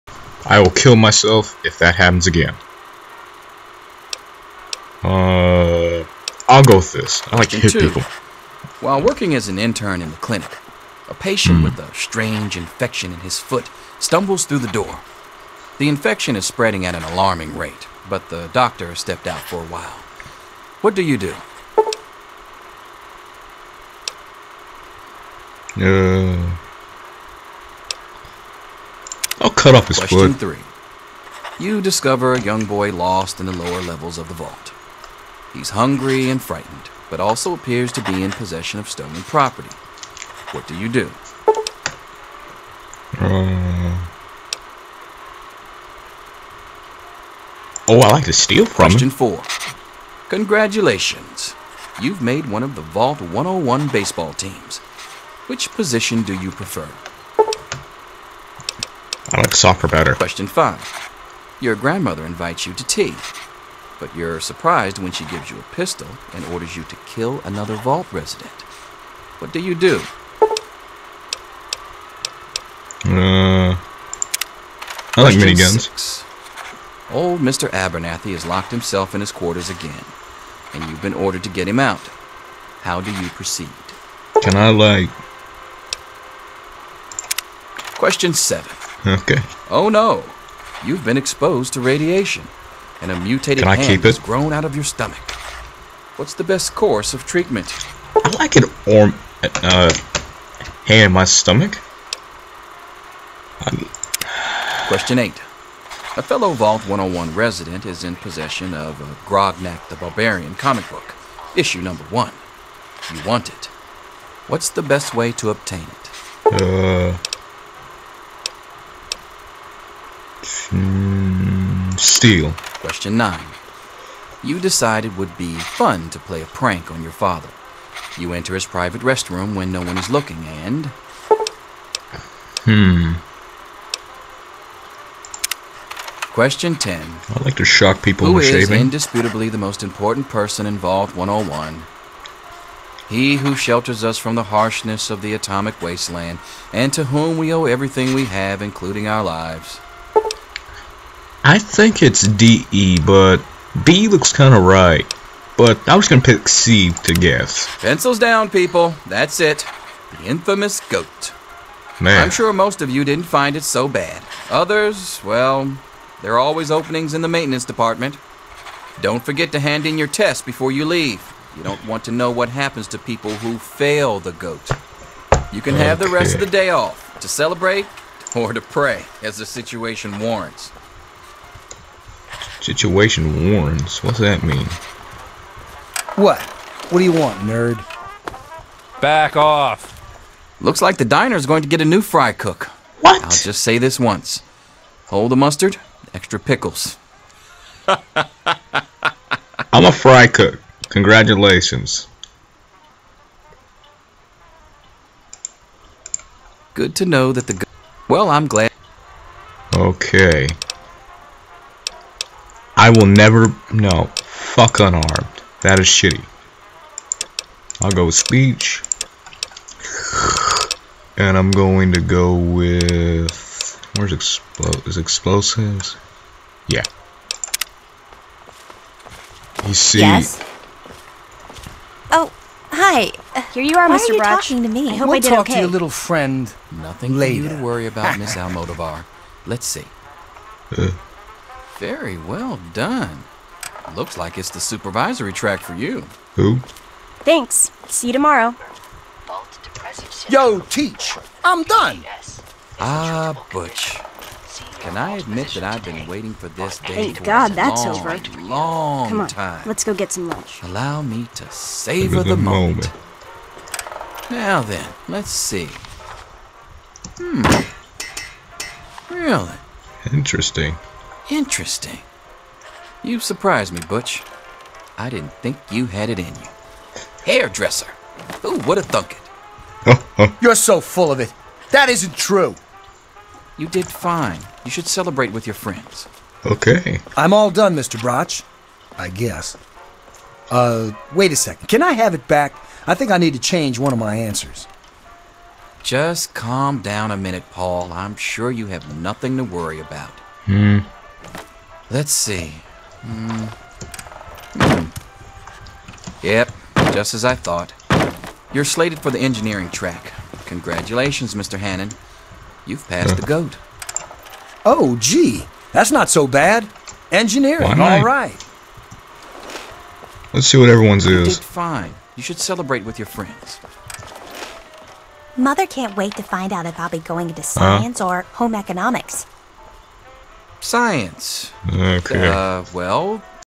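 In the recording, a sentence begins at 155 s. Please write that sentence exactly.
But I was going to pick C to guess.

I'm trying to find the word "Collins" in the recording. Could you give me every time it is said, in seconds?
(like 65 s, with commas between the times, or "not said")
not said.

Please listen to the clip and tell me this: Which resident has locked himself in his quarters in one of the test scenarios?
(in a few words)
Mr. Abernathy.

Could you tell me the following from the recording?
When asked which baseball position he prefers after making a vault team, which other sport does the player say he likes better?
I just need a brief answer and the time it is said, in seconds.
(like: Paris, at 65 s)
Soccer, at 59 s.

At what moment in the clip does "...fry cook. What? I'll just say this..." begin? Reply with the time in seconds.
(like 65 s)
192 s.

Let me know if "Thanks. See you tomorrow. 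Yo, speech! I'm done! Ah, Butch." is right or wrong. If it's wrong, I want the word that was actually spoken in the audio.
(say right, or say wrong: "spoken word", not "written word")
wrong: "teach", not "speech".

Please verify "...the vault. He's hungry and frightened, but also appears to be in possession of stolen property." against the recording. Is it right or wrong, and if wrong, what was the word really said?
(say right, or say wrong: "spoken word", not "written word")
right.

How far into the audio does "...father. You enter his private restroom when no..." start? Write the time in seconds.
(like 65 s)
127 s.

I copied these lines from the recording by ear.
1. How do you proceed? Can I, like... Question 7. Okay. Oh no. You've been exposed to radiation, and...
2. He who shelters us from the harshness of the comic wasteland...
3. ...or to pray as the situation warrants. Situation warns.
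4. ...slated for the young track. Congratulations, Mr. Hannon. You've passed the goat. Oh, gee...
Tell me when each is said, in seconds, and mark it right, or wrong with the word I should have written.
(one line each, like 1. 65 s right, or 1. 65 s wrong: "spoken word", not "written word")
1. 82 s right
2. 143 s wrong: "atomic", not "comic"
3. 178 s right
4. 308 s wrong: "engineering", not "young".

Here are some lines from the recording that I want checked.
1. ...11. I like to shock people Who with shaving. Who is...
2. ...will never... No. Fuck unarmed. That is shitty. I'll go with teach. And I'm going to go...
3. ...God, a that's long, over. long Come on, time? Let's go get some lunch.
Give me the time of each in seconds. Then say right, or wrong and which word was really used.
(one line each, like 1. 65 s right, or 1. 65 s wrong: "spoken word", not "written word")
1. 136 s wrong: "10", not "11"
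2. 212 s wrong: "speech", not "teach"
3. 257 s right.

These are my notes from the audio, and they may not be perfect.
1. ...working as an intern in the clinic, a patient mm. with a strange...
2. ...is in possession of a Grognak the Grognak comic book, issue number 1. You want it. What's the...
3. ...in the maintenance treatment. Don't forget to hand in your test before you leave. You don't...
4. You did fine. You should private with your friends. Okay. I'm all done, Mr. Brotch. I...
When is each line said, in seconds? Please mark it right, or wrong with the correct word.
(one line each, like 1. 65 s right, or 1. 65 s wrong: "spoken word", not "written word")
1. 9 s right
2. 107 s wrong: "Barbarian", not "Grognak"
3. 167 s wrong: "department", not "treatment"
4. 283 s wrong: "celebrate", not "private".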